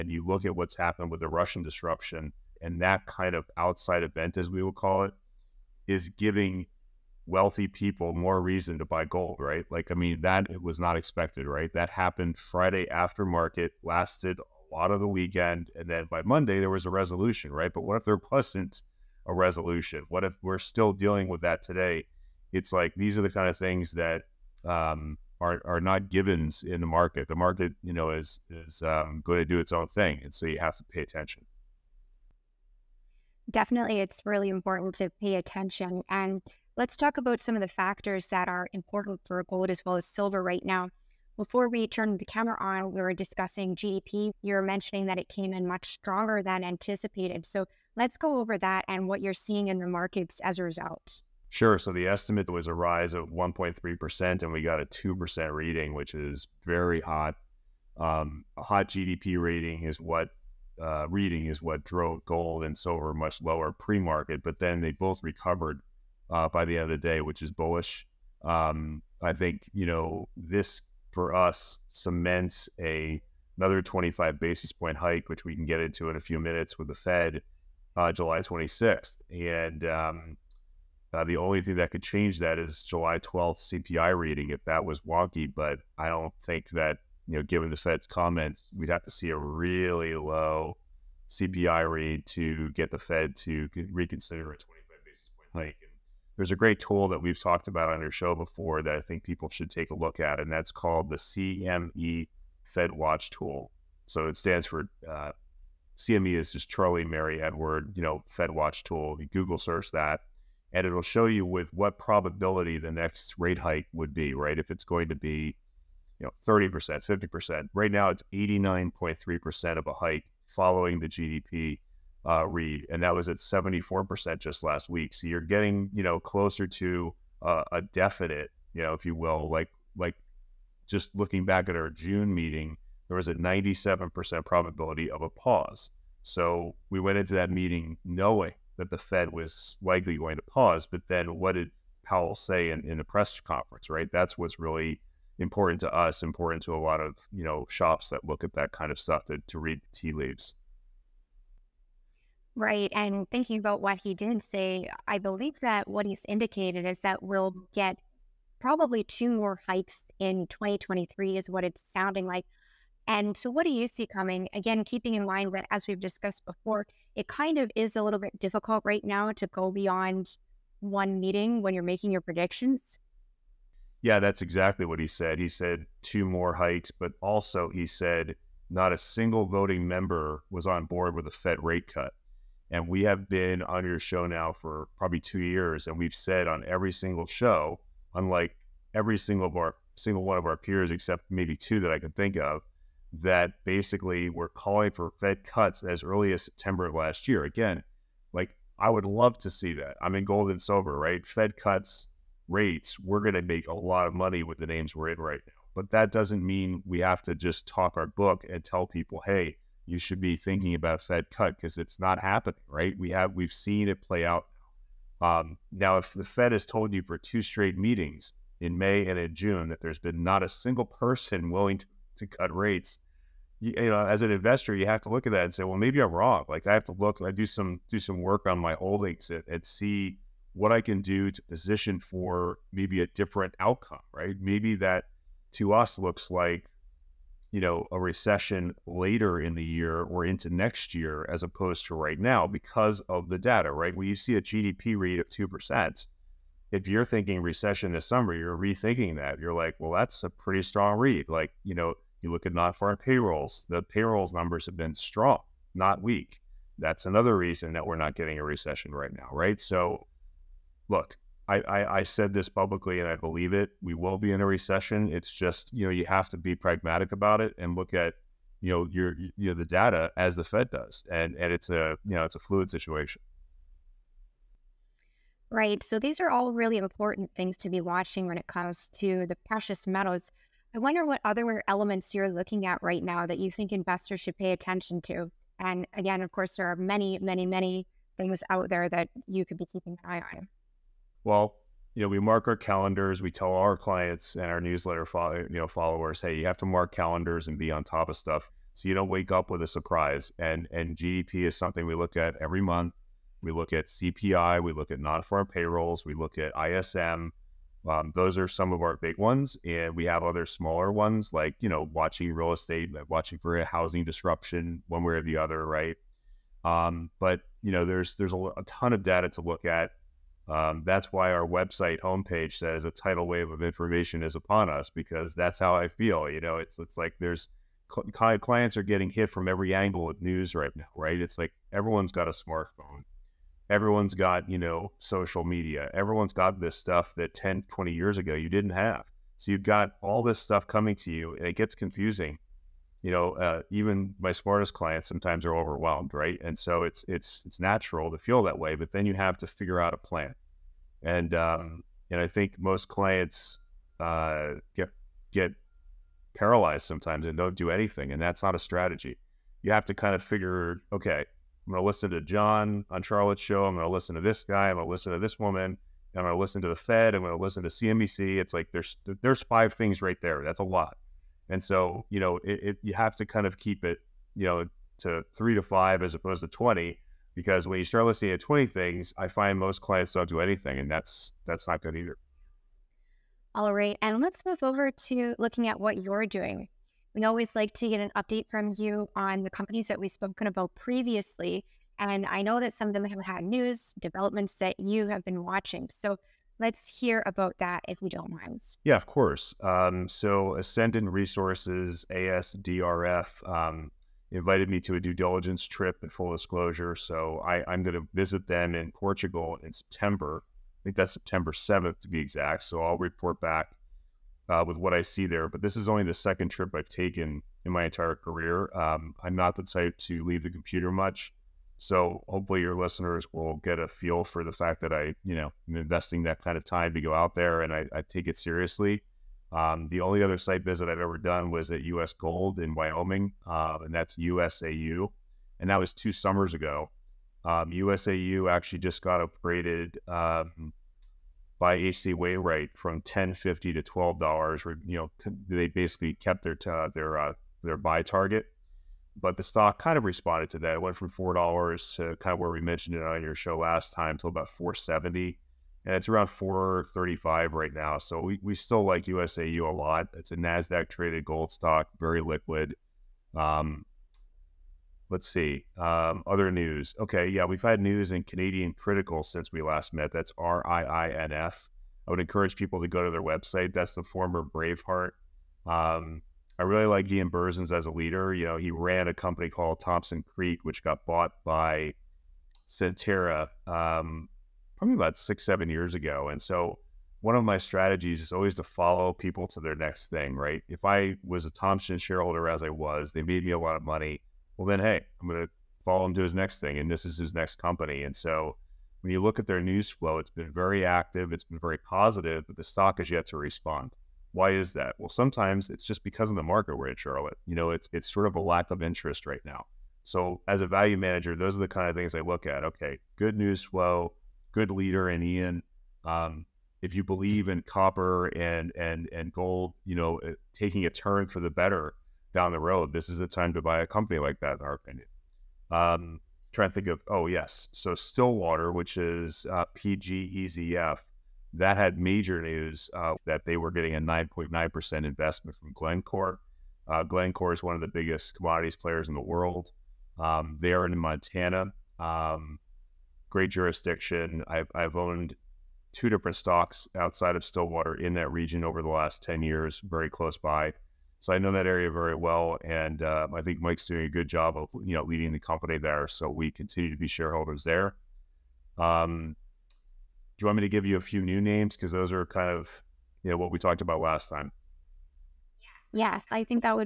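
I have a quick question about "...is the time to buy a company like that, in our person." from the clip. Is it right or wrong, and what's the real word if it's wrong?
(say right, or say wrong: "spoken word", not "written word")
wrong: "opinion", not "person".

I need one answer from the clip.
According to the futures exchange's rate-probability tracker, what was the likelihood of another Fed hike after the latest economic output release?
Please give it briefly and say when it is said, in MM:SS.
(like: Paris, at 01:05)
89.3%, at 01:58.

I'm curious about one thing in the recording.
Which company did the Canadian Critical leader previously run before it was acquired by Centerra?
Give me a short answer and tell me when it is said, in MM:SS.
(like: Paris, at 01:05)
Thompson Creek, at 07:59.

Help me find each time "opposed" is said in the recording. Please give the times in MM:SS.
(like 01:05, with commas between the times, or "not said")
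04:01, 06:16.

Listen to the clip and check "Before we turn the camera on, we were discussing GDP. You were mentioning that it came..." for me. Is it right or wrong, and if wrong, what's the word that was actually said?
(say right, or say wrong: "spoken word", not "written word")
right.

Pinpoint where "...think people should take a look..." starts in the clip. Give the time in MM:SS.
01:39.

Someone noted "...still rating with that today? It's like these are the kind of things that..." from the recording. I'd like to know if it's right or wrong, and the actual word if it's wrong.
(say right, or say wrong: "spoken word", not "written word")
wrong: "dealing", not "rating".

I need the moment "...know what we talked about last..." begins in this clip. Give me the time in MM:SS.
09:23.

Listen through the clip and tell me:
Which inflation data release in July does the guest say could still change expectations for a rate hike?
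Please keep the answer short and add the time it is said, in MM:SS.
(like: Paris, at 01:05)
July 12th CPI, at 01:22.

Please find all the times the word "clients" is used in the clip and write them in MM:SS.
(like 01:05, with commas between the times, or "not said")
04:53, 05:28, 05:44, 05:52, 06:19.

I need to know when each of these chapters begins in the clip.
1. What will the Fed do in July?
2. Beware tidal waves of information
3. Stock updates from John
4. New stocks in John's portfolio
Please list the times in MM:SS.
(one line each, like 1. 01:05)
1. 00:31
2. 04:33
3. 06:22
4. 09:18.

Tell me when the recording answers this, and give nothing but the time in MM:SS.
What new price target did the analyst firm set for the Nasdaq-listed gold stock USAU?
07:23.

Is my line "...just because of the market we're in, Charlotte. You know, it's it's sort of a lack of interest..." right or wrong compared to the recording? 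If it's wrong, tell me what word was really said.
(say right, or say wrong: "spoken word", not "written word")
right.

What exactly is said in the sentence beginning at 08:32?
Okay, good news flow, good leader in Ian.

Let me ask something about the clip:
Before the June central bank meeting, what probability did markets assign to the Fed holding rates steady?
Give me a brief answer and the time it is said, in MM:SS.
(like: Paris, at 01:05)
97%, at 02:13.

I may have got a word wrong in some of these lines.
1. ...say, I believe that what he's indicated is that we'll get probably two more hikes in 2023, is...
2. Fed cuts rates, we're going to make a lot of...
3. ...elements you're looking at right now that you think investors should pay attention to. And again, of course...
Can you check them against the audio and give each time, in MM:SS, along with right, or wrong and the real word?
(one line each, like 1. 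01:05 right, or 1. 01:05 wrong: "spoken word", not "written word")
1. 02:34 right
2. 03:21 right
3. 04:41 right.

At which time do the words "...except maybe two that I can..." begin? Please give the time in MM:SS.
03:10.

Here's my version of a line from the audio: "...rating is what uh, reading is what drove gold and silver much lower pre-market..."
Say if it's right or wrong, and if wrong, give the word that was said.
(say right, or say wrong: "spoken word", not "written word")
right.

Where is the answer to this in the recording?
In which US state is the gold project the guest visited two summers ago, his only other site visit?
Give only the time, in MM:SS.
07:12.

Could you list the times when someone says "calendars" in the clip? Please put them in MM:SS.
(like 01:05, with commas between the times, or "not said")
04:52, 04:56.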